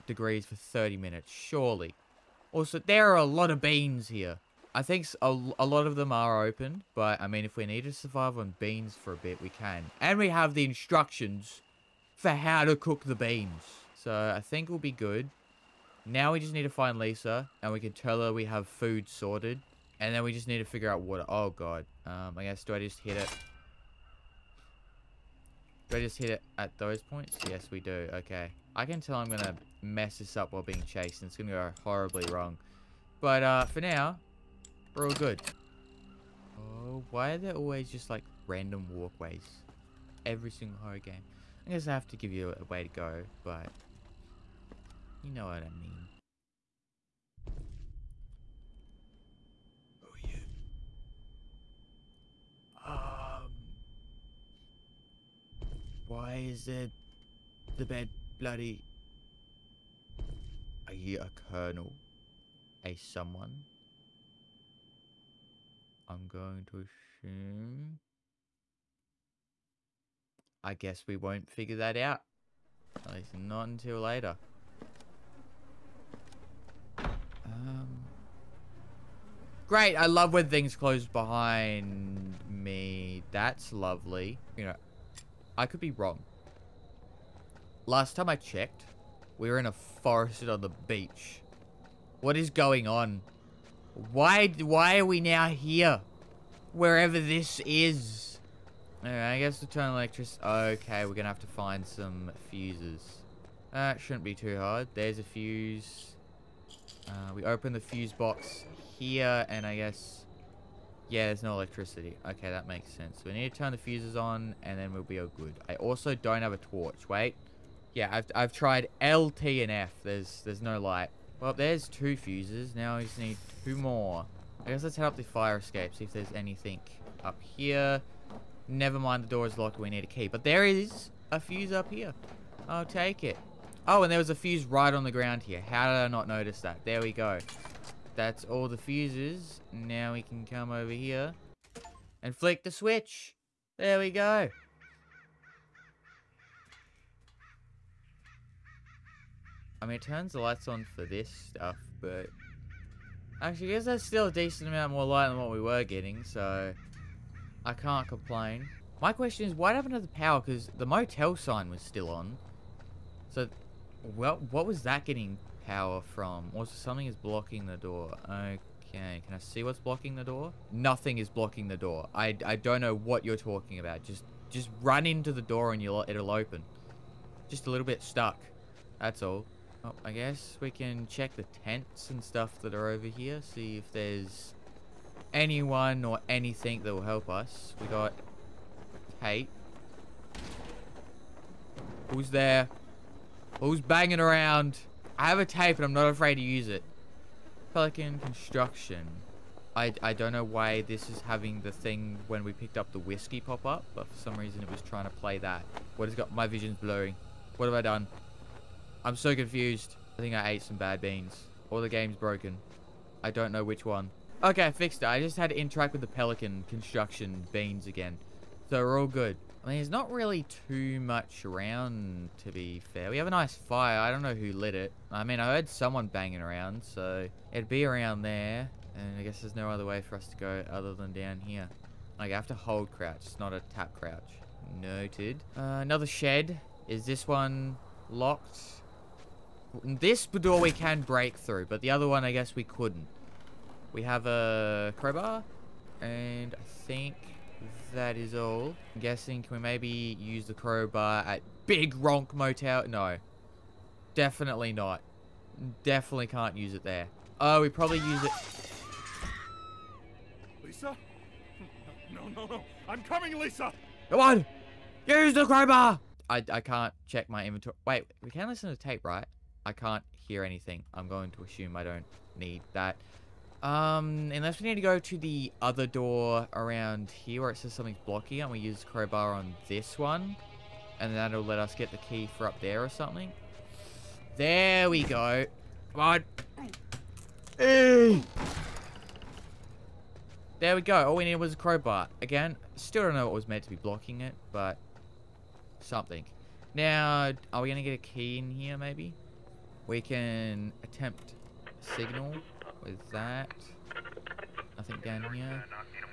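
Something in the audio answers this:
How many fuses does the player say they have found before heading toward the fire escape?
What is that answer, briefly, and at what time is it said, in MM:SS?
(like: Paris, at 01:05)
2, at 02:01.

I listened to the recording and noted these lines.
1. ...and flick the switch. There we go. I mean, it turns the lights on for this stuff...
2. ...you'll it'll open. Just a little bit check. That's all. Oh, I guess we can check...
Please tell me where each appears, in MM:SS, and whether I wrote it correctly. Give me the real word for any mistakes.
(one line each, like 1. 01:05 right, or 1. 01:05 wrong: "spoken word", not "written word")
1. 02:22 right
2. 02:55 wrong: "stuck", not "check".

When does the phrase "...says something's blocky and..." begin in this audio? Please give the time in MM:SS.
04:37.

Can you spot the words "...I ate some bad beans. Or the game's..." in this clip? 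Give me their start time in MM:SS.
03:30.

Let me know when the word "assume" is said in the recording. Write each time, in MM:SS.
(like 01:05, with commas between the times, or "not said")
01:06, 04:31.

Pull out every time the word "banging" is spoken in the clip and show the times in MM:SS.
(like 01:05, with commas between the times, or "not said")
03:13, 03:46.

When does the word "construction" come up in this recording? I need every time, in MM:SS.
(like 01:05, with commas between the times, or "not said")
03:18, 03:36.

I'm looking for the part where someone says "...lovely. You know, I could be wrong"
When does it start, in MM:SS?
01:23.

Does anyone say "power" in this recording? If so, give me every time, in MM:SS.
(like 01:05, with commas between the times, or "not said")
02:40, 02:45.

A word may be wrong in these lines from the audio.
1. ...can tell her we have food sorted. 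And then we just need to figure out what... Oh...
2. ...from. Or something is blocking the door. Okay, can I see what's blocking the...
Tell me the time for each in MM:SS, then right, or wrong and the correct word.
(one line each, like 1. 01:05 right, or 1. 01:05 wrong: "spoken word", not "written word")
1. 00:17 right
2. 02:46 right.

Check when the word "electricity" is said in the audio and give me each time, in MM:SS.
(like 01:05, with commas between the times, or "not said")
01:39, 01:51.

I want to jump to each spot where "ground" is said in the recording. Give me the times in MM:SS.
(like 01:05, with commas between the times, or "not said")
02:15.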